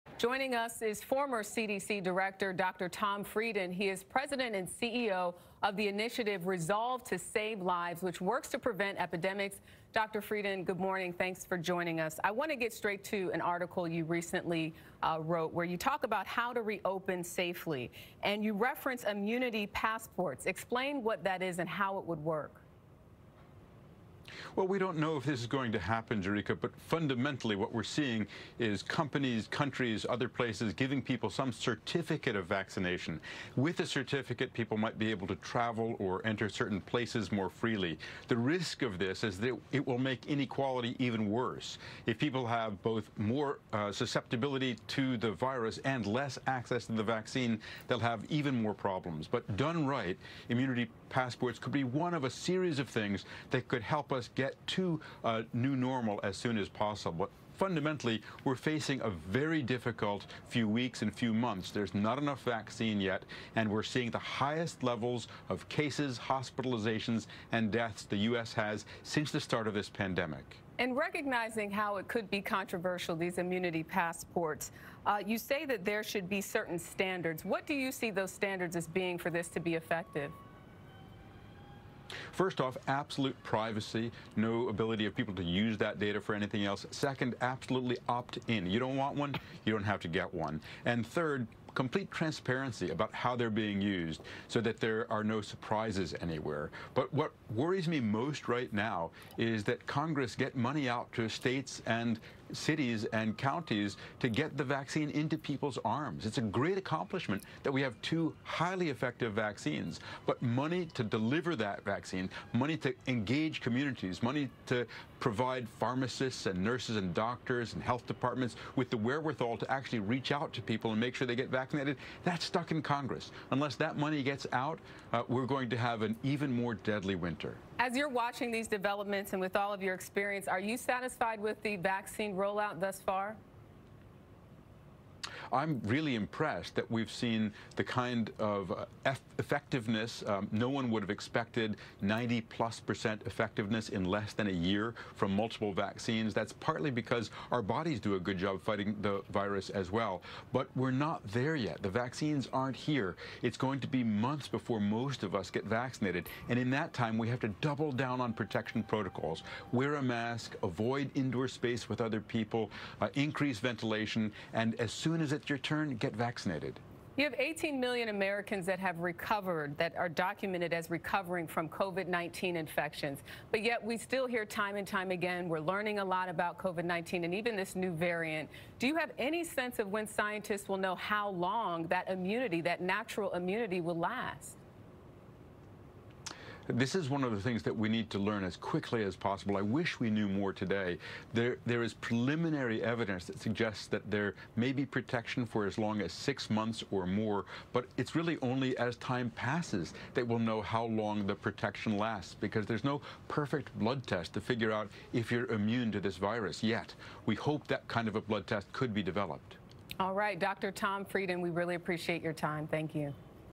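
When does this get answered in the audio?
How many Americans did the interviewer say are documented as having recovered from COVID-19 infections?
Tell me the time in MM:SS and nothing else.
02:47.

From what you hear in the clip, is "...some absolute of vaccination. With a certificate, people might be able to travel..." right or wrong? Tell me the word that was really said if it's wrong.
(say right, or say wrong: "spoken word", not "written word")
wrong: "certificate", not "absolute".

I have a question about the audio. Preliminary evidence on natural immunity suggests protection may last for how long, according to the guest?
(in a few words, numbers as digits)
6 months or more.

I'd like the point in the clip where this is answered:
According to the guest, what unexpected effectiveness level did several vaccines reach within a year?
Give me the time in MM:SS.
02:22.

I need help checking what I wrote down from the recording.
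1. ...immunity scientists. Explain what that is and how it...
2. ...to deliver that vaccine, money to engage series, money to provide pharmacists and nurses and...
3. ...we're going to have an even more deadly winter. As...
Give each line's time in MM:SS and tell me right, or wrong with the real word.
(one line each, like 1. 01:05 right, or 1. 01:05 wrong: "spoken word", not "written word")
1. 00:19 wrong: "passports", not "scientists"
2. 01:50 wrong: "communities", not "series"
3. 02:05 right.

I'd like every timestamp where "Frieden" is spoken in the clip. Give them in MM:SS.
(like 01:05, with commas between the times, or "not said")
00:03, 00:10, 03:31.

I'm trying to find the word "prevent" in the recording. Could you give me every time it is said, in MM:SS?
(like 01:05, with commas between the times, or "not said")
00:08.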